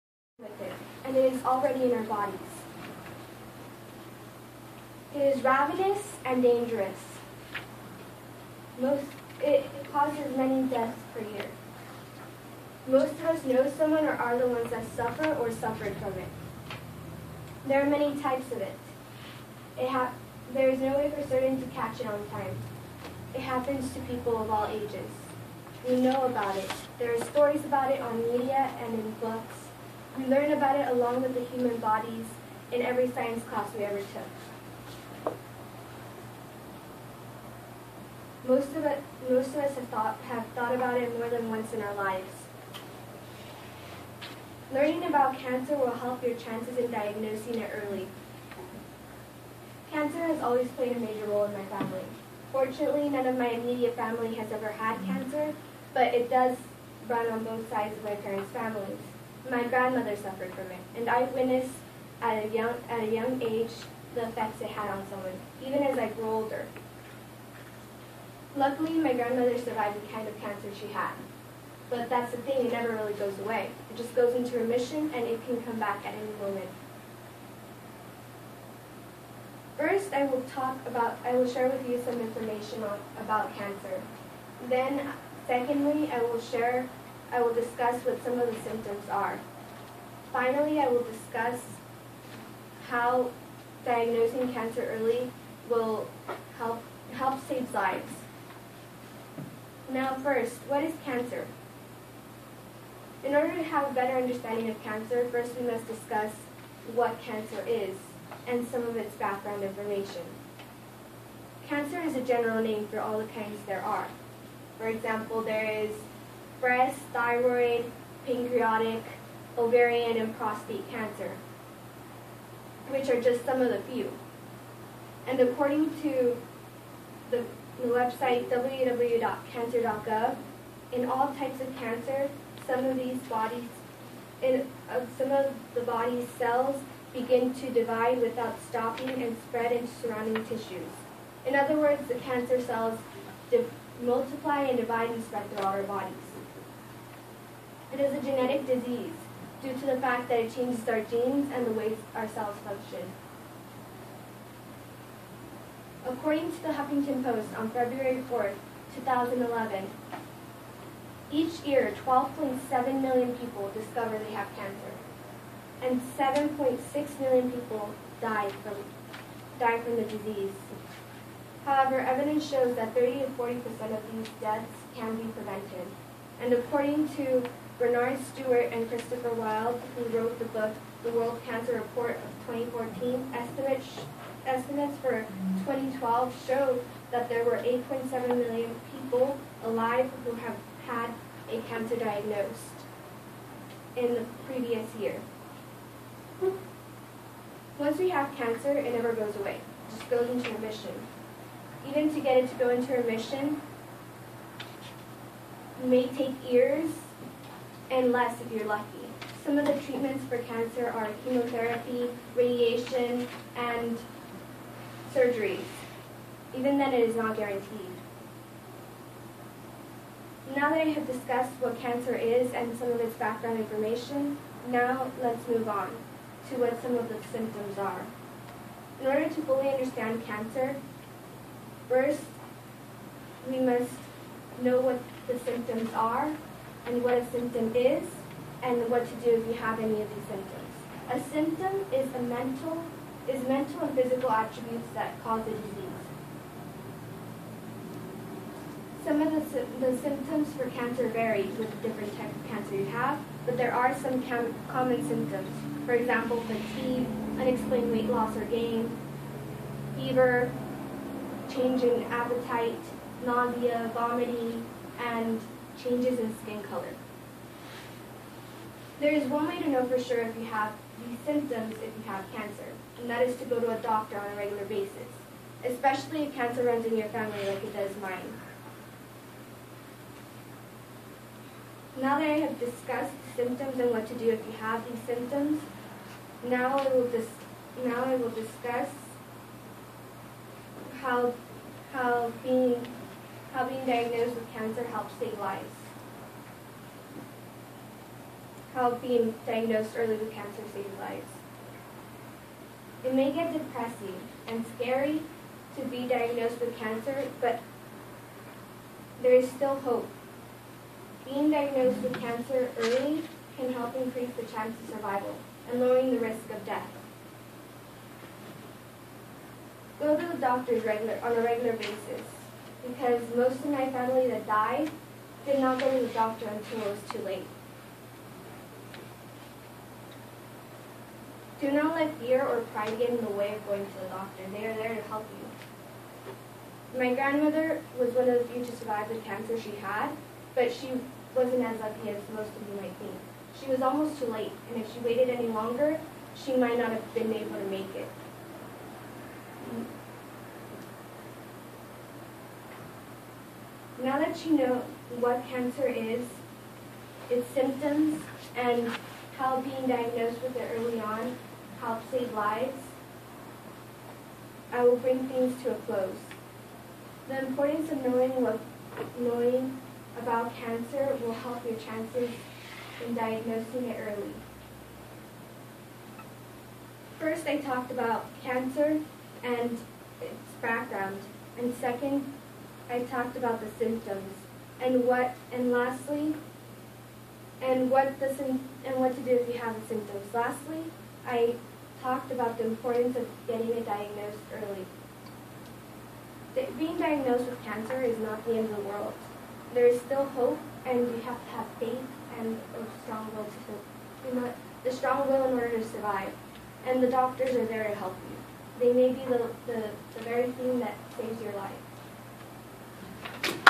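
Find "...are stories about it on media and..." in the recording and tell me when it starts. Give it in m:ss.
0:27.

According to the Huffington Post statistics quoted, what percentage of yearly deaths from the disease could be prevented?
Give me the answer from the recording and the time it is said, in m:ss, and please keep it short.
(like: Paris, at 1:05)
30 to 40%, at 2:52.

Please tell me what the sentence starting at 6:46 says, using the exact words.
And the doctors are there to help you.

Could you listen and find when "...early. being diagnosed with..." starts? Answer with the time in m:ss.
6:34.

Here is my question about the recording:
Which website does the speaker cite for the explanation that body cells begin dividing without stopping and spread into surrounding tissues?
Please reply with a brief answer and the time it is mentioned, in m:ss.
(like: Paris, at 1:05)
www.cancer.gov, at 2:08.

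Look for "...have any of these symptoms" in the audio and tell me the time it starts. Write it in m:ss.
3:59.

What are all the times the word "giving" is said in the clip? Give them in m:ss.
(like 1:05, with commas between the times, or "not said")
not said.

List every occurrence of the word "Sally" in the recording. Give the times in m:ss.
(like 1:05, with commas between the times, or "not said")
not said.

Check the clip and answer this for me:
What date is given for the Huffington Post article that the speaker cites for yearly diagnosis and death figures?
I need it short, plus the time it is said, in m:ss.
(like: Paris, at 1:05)
February 4, 2011, at 2:37.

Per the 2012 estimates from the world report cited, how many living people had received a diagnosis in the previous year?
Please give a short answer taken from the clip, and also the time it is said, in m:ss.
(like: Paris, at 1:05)
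8.7 million, at 3:07.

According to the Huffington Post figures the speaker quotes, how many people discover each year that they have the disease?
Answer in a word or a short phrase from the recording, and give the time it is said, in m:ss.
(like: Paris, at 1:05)
12.7 million, at 2:42.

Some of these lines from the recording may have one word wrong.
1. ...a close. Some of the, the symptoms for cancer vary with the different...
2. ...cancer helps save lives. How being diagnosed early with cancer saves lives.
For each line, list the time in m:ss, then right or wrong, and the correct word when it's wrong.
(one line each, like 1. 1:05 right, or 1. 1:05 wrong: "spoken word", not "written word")
1. 4:05 wrong: "disease", not "close"
2. 4:54 right.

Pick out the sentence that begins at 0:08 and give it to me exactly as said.
Most, it, it causes many deaths per year.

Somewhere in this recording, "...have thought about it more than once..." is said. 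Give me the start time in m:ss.
0:40.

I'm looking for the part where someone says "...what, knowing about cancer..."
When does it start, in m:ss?
6:08.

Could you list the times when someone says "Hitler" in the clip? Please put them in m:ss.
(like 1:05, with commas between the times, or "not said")
not said.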